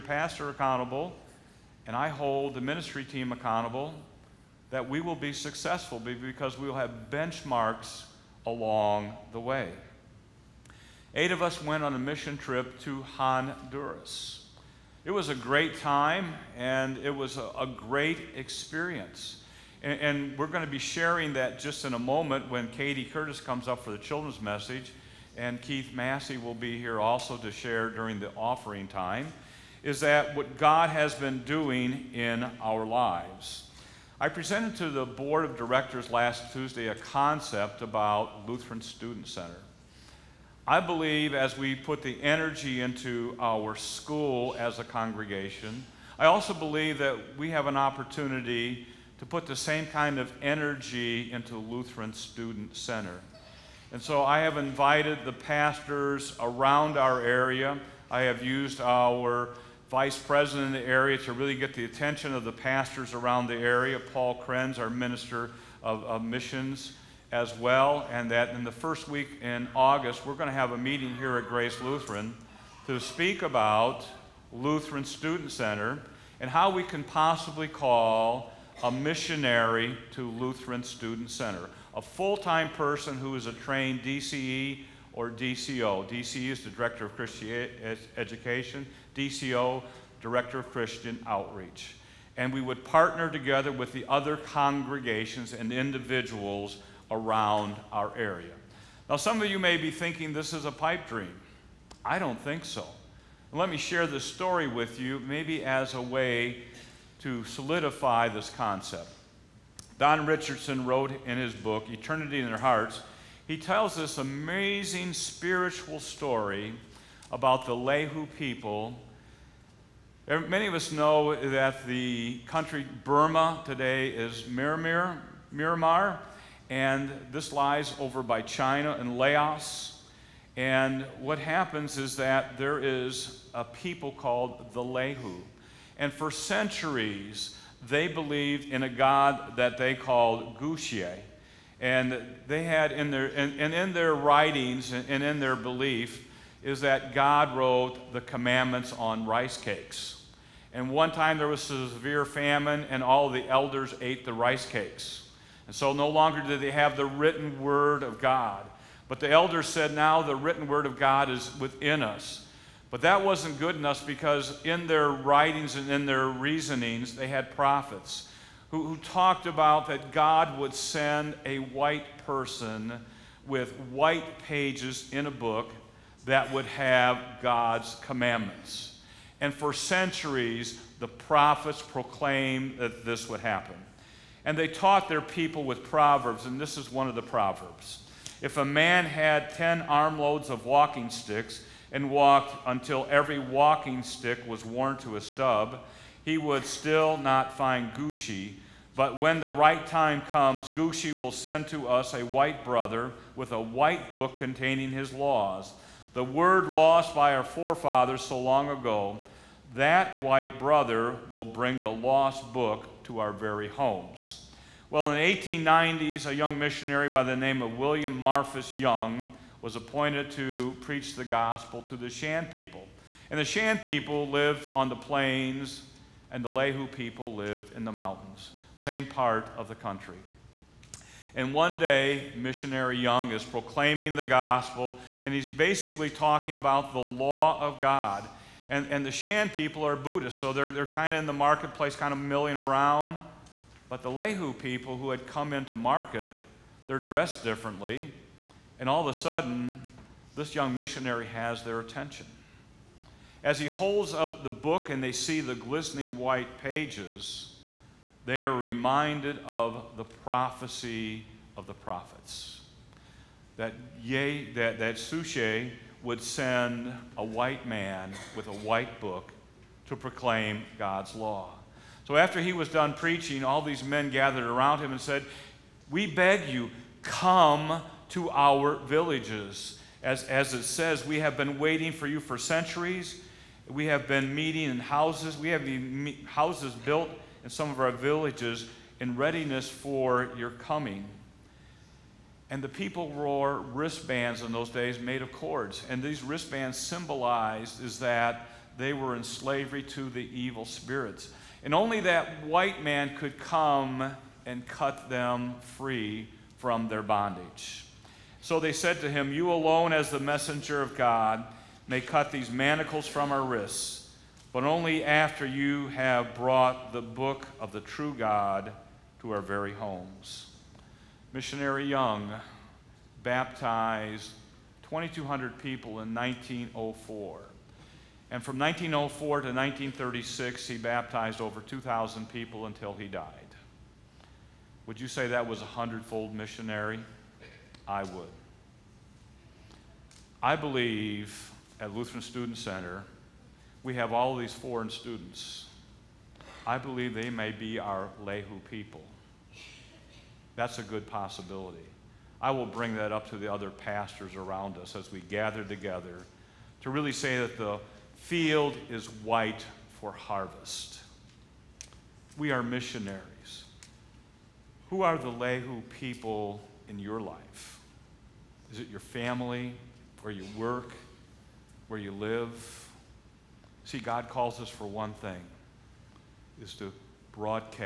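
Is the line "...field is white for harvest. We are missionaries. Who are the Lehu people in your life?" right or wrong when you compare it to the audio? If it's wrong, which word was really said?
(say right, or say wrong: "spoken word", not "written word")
right.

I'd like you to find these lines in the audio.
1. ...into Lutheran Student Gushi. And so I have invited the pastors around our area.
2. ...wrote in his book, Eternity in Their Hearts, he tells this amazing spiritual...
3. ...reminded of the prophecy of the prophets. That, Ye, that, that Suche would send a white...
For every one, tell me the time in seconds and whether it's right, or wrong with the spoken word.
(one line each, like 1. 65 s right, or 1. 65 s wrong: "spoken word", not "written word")
1. 51 s wrong: "Center", not "Gushi"
2. 110 s right
3. 258 s right.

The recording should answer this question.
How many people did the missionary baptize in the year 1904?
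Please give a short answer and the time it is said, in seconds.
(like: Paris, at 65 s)
2,200, at 324 s.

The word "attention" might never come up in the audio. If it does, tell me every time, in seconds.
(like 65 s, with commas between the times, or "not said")
61 s, 251 s.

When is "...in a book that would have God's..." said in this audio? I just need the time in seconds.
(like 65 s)
175 s.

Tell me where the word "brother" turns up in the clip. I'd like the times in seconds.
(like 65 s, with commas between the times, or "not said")
202 s, 210 s.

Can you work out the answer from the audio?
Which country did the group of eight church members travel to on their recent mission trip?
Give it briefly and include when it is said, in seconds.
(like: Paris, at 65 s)
Honduras, at 13 s.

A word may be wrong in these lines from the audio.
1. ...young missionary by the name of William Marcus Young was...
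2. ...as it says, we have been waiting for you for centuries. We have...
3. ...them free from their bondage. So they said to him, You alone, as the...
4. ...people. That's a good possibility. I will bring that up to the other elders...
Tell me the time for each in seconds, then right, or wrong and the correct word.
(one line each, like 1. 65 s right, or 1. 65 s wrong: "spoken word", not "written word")
1. 216 s right
2. 280 s right
3. 305 s right
4. 348 s wrong: "pastors", not "elders".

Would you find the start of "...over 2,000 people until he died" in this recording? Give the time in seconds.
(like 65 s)
331 s.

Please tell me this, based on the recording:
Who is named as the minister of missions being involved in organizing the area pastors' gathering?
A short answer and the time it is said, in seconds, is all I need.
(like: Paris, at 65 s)
Paul Krenz, at 63 s.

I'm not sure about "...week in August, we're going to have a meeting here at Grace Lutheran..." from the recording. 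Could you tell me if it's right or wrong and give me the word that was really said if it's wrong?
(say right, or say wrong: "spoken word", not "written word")
right.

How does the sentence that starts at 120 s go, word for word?
Many of us know that the country Burma today is Miramar, Miramar and this lies over by China and Laos.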